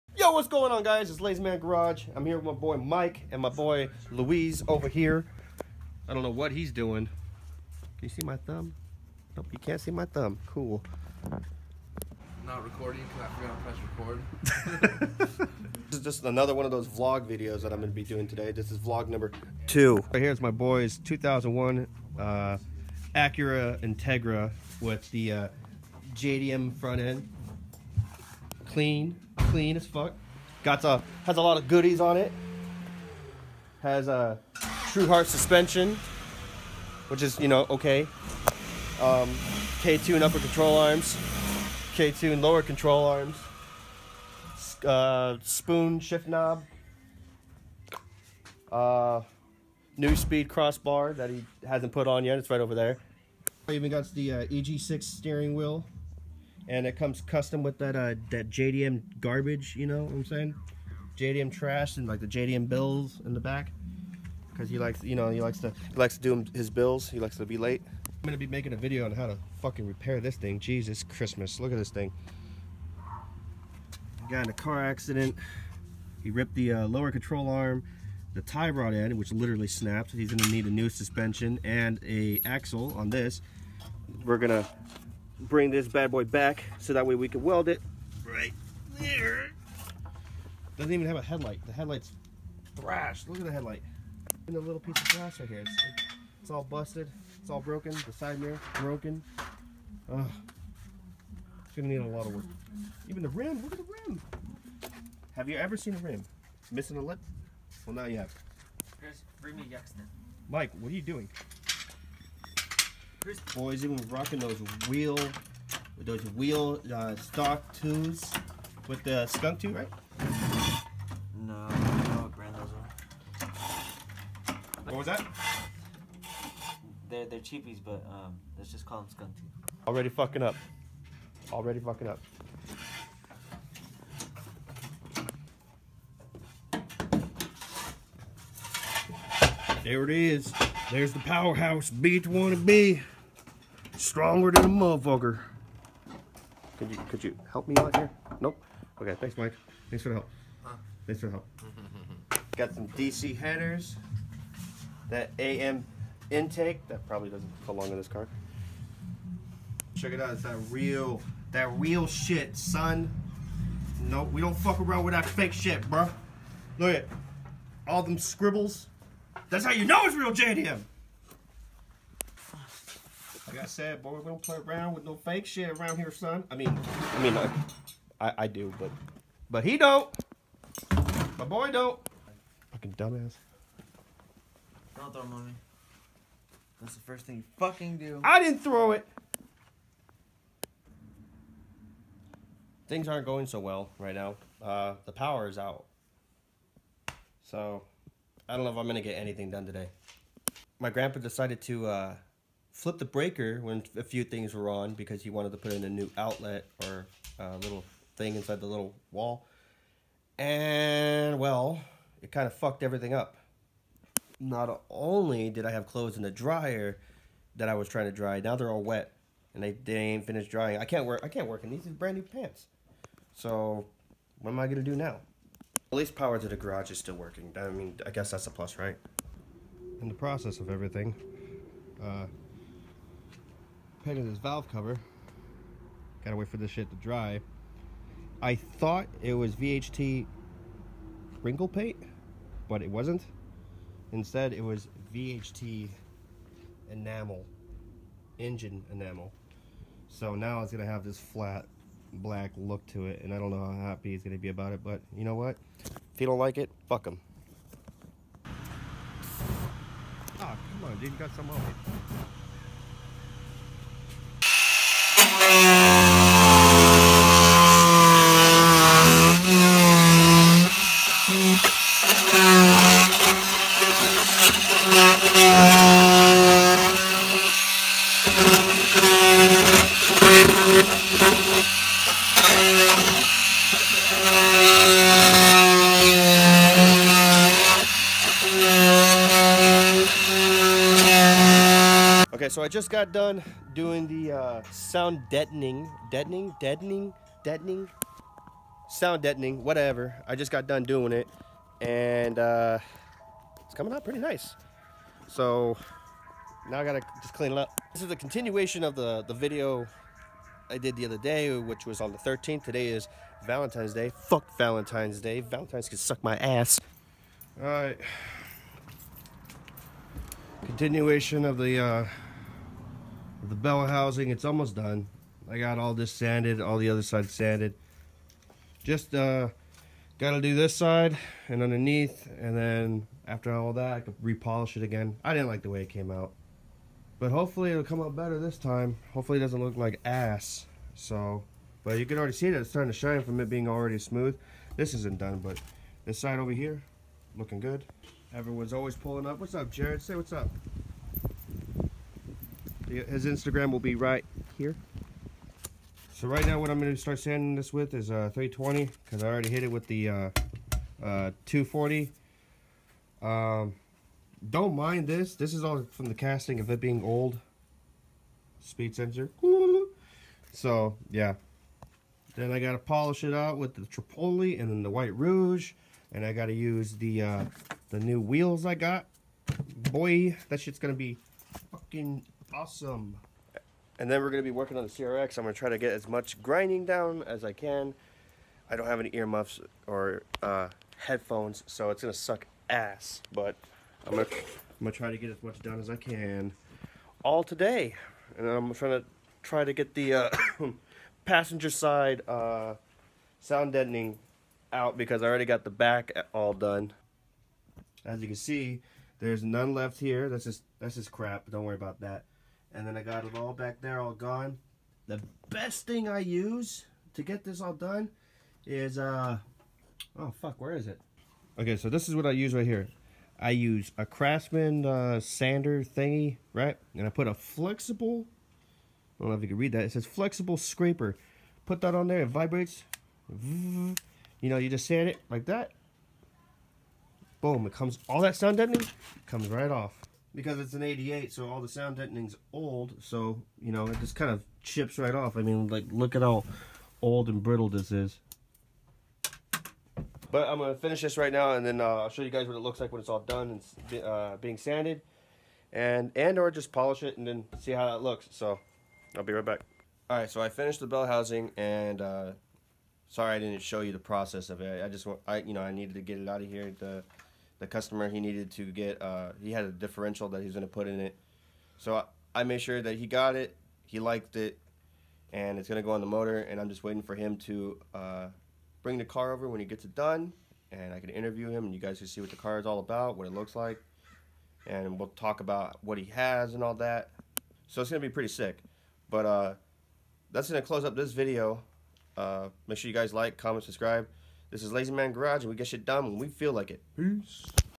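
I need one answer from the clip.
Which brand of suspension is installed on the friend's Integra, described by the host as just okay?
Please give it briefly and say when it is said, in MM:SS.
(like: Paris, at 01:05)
Truhart, at 00:34.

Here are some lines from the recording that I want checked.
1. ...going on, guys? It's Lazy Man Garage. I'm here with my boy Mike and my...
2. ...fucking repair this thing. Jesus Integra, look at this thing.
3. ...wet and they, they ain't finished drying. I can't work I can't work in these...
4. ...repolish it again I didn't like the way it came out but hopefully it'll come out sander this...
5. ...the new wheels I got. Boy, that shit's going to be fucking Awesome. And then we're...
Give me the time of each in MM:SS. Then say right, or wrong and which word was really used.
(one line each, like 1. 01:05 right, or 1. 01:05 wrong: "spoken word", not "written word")
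1. 00:00 right
2. 01:09 wrong: "Christmas", not "Integra"
3. 03:38 right
4. 05:34 wrong: "better", not "sander"
5. 06:17 right.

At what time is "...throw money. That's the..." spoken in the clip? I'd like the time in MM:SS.
03:05.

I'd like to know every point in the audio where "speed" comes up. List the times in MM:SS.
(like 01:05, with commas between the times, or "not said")
00:50, 06:08.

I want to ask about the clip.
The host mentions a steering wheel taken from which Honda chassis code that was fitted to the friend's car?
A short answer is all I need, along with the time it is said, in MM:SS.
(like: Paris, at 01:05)
EG6, at 00:54.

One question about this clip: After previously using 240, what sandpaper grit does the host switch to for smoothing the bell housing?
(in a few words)
320.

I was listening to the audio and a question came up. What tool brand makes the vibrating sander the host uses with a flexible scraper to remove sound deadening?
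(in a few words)
Craftsman.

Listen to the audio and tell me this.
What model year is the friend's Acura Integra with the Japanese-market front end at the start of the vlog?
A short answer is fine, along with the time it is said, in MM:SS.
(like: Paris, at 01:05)
2001, at 00:20.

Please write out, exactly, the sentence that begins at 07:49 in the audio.
Uh, he had a differential that he was going to put in it, so I, I made sure that he got it.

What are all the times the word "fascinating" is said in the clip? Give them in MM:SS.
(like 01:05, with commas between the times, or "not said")
not said.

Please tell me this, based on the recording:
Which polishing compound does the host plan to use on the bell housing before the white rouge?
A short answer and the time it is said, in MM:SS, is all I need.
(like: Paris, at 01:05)
Tripoli, at 06:13.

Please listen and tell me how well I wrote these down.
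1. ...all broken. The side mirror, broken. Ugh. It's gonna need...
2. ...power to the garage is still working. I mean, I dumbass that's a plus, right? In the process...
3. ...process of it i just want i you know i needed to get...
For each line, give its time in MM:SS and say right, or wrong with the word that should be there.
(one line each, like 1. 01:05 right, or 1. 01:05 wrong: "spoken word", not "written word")
1. 01:37 right
2. 03:46 wrong: "guess", not "dumbass"
3. 07:43 right.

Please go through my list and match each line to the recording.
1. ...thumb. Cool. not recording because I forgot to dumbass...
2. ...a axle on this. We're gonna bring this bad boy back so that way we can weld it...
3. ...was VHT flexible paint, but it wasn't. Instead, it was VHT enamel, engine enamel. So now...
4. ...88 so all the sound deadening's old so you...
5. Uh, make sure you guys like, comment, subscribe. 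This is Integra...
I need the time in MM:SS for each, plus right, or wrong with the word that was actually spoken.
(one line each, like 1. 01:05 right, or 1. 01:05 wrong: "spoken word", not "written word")
1. 00:10 wrong: "press", not "dumbass"
2. 01:22 right
3. 03:59 wrong: "wrinkle", not "flexible"
4. 07:20 right
5. 08:12 wrong: "Lazy", not "Integra".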